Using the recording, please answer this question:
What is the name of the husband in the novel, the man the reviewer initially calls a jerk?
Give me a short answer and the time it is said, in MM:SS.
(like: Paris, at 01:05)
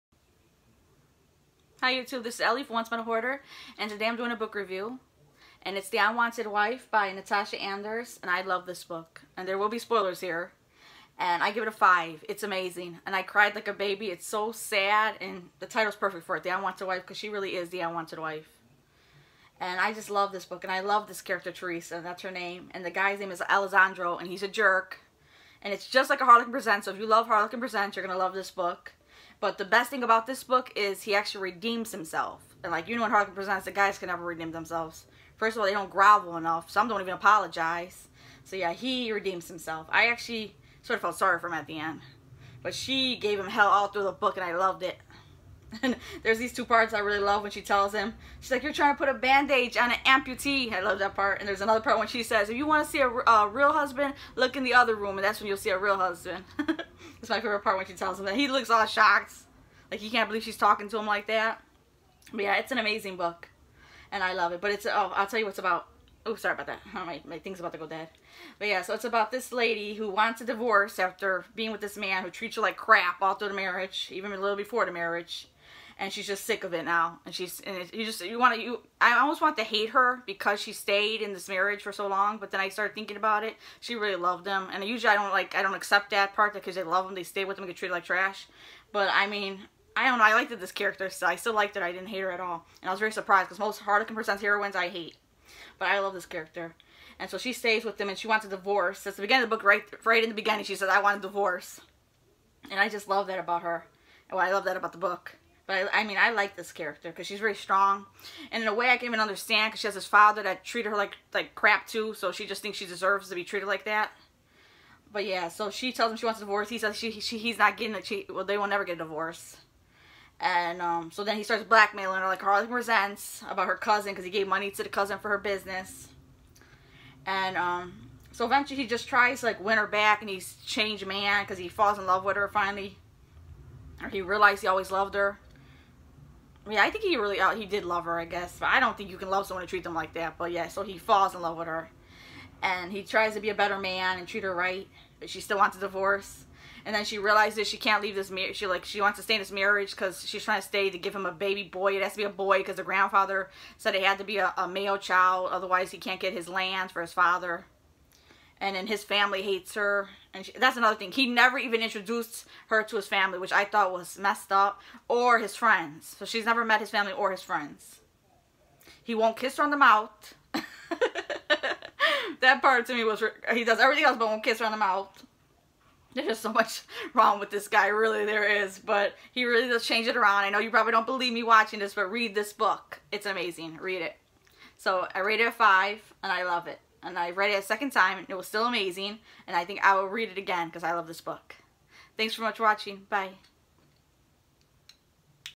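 Alessandro, at 00:23.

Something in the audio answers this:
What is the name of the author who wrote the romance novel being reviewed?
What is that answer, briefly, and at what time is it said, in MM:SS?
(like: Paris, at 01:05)
Natasha Anders, at 00:07.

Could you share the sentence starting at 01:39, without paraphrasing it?
That's the beginning of the book, right, right in the beginning.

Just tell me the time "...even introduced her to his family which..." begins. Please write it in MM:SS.
02:41.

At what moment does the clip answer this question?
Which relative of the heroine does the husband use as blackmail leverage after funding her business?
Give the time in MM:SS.
02:03.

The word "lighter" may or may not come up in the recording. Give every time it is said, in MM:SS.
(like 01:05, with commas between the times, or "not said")
not said.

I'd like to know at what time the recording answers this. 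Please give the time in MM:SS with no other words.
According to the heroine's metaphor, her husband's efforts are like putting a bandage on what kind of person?
00:49.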